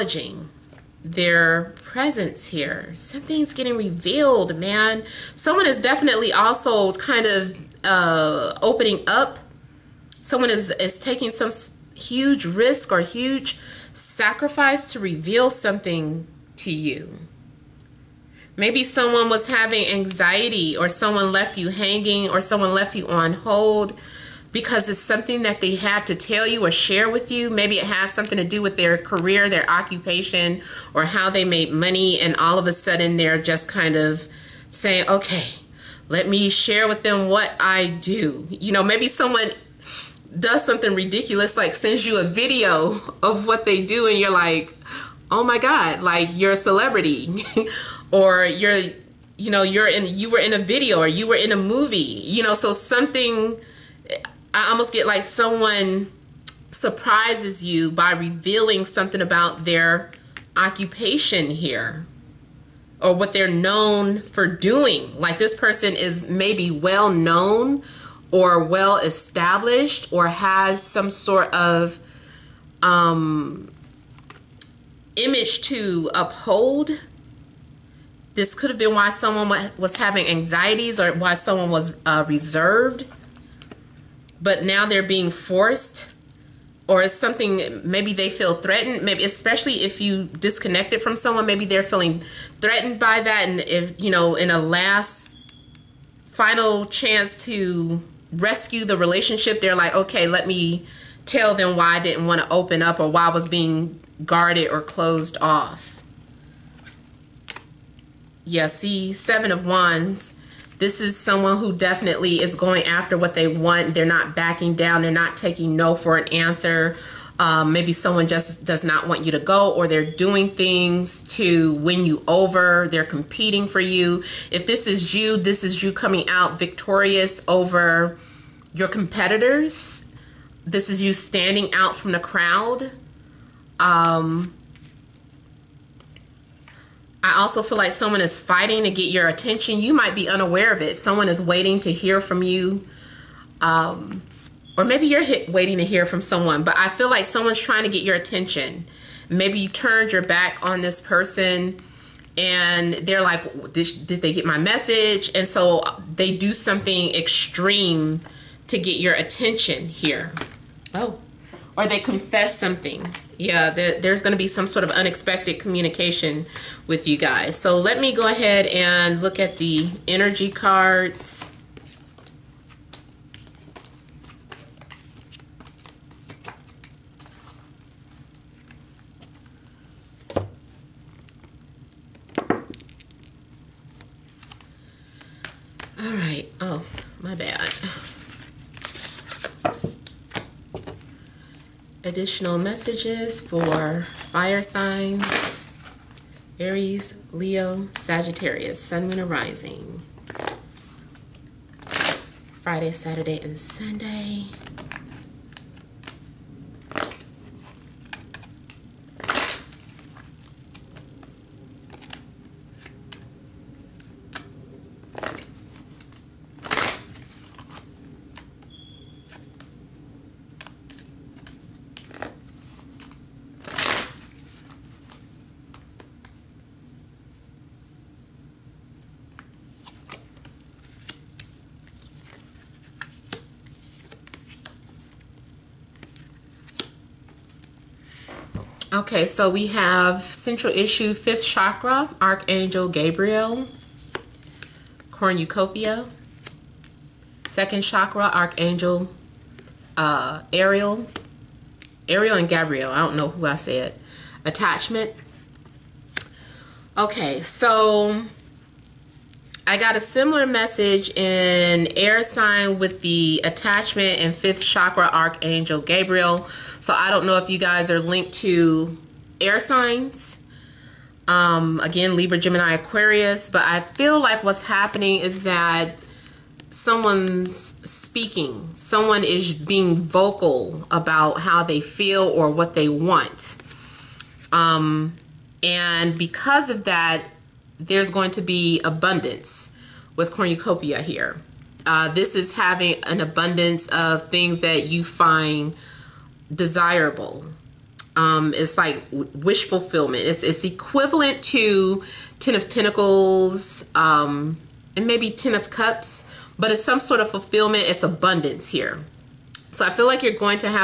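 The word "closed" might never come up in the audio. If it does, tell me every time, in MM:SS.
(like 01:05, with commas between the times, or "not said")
01:44.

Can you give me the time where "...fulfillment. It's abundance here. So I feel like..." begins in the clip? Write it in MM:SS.
05:07.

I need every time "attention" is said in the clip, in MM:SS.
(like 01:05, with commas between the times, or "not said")
02:19, 02:28, 02:39.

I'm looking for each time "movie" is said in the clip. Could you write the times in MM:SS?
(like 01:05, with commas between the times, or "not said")
00:51.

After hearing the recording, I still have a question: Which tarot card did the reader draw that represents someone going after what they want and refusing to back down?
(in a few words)
Seven of Wands.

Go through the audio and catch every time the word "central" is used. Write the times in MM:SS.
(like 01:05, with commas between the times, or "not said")
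04:00.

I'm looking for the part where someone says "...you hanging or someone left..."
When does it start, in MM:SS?
00:21.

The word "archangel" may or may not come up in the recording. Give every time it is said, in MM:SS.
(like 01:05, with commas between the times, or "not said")
04:02, 04:08, 04:25.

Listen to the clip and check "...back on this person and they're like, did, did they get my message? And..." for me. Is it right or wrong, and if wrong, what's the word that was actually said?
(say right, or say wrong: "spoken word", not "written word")
right.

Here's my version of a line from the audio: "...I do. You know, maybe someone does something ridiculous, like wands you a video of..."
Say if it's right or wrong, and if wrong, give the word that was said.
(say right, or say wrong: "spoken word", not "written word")
wrong: "sends", not "wands".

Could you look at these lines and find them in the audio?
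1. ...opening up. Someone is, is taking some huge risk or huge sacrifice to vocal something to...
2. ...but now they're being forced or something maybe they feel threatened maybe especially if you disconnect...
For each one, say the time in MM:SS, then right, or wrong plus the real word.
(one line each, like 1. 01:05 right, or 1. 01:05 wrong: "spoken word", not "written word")
1. 00:08 wrong: "reveal", not "vocal"
2. 01:24 right.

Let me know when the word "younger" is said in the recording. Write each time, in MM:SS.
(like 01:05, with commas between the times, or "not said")
not said.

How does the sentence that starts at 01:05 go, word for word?
Like this person is maybe well known or well established or has some sort of um, image to uphold.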